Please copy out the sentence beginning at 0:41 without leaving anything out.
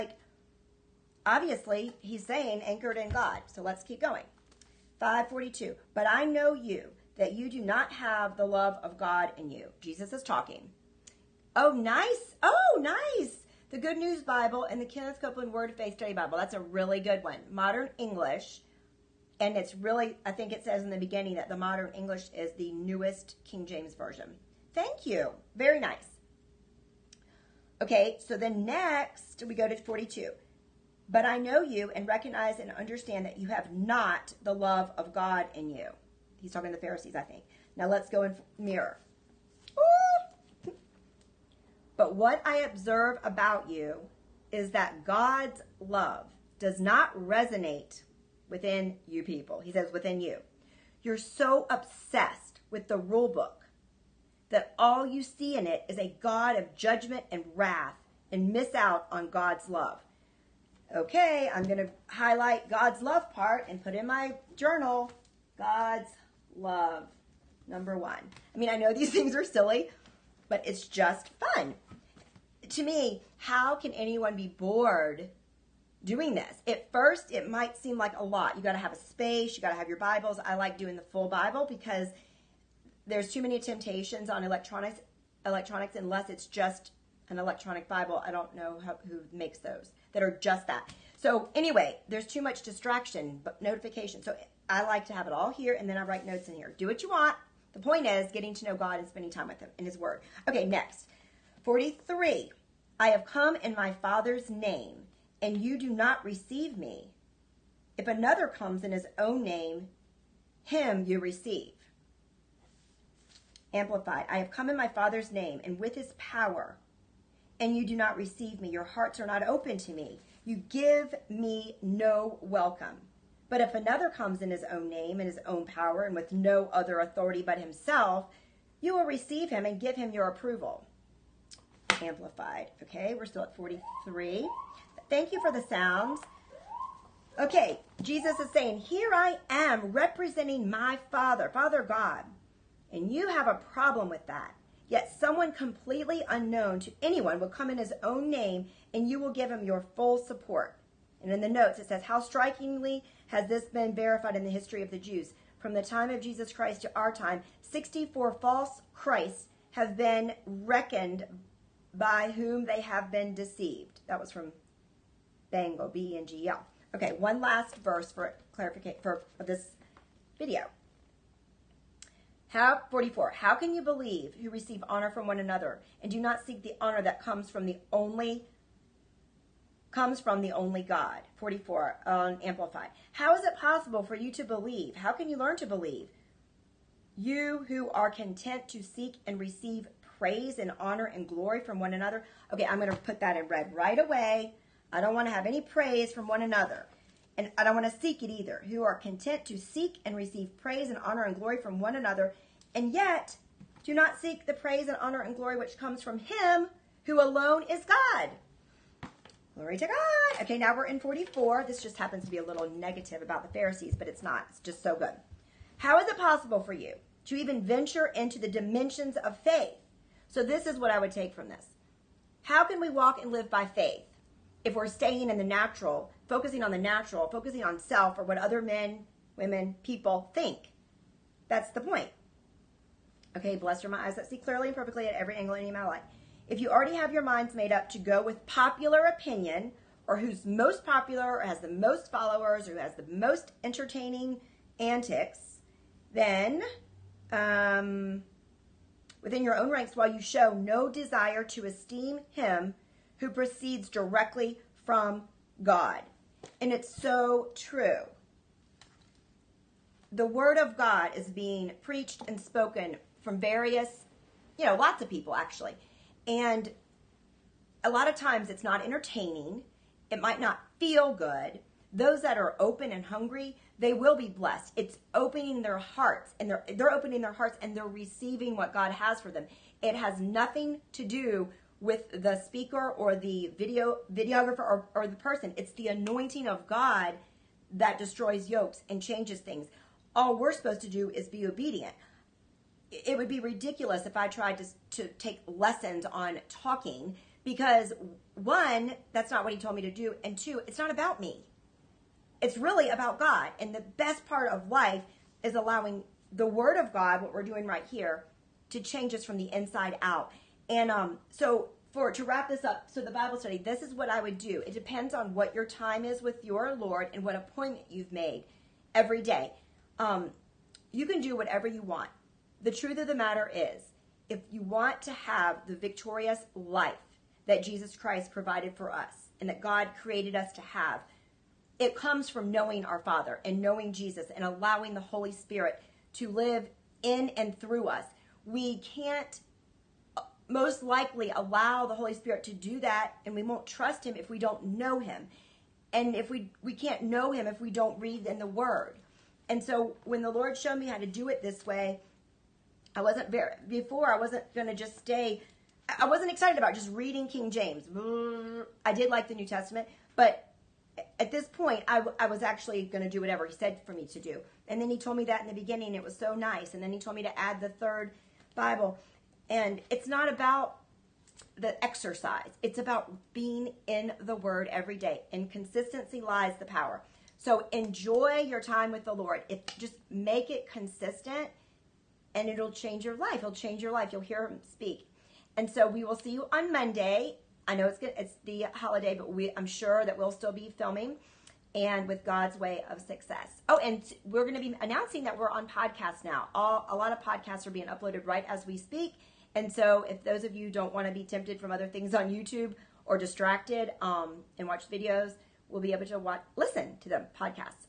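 but what i observe about you is that god's love does not resonate within you people.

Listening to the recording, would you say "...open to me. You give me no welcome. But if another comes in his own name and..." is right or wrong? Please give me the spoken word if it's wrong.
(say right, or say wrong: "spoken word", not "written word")
right.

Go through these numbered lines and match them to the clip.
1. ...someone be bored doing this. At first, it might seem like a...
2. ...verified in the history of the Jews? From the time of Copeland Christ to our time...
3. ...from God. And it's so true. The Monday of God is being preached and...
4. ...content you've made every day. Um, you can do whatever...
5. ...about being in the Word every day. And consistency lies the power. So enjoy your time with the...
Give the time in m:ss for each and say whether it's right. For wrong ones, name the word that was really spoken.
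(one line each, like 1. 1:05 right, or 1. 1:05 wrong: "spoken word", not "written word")
1. 1:13 wrong: "anyone", not "someone"
2. 2:33 wrong: "Jesus", not "Copeland"
3. 4:14 wrong: "Word", not "Monday"
4. 5:17 wrong: "appointment", not "content"
5. 6:12 right.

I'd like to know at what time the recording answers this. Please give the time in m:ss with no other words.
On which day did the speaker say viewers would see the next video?
6:26.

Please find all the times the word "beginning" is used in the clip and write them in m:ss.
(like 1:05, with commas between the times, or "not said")
0:20, 6:05.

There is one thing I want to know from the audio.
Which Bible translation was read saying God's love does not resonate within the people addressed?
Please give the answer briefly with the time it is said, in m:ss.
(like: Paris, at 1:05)
Mirror, at 0:38.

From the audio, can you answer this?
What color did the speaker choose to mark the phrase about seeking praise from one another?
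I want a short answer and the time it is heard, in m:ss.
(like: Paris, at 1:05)
Red, at 3:13.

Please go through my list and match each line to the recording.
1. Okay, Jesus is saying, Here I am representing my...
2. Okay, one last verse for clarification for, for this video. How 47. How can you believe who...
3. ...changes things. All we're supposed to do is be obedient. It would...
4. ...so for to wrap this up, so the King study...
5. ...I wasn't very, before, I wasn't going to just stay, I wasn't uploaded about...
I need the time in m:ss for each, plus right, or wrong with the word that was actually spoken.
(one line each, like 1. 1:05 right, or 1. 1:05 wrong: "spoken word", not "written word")
1. 2:17 right
2. 2:46 wrong: "44", not "47"
3. 4:49 right
4. 5:11 wrong: "Bible", not "King"
5. 5:52 wrong: "excited", not "uploaded".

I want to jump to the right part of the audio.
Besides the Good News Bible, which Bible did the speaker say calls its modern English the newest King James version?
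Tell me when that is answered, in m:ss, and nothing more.
0:14.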